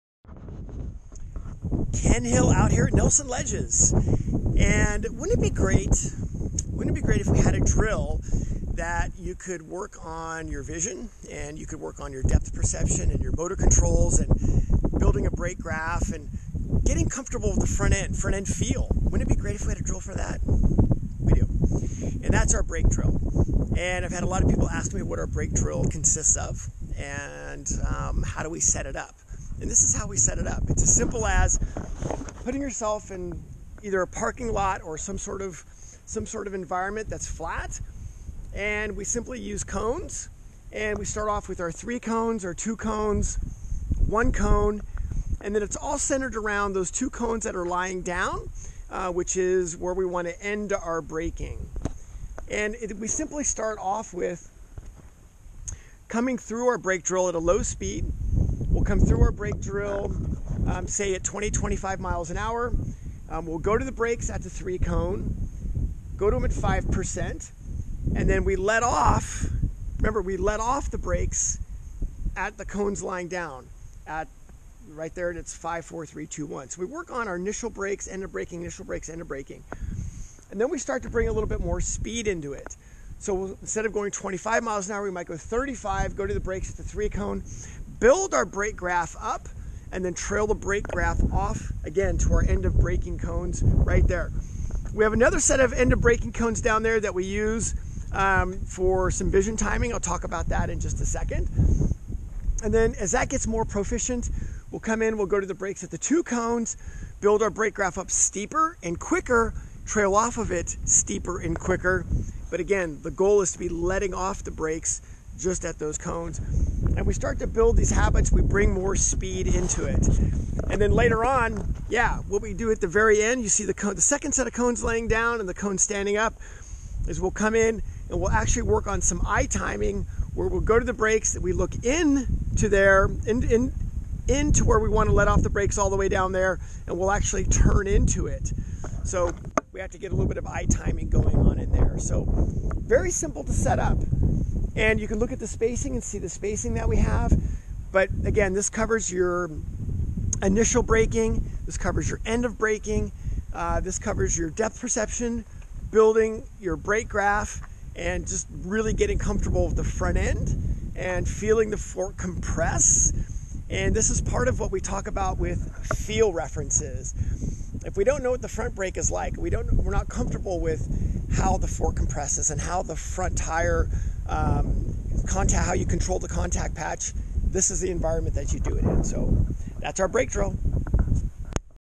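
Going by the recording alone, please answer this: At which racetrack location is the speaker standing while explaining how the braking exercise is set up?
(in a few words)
Nelson Ledges.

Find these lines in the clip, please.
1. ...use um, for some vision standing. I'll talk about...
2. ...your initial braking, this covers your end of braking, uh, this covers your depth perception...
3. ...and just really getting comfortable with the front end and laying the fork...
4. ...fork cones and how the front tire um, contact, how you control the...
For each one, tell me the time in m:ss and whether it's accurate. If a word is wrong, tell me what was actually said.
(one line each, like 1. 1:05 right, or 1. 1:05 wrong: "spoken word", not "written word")
1. 1:37 wrong: "timing", not "standing"
2. 2:29 right
3. 2:37 wrong: "feeling", not "laying"
4. 2:51 wrong: "compresses", not "cones".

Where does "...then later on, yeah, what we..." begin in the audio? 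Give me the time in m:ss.
2:00.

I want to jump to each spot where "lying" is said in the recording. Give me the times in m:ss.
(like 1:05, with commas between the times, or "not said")
0:47, 1:13.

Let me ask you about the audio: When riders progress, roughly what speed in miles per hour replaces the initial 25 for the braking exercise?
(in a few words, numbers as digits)
35.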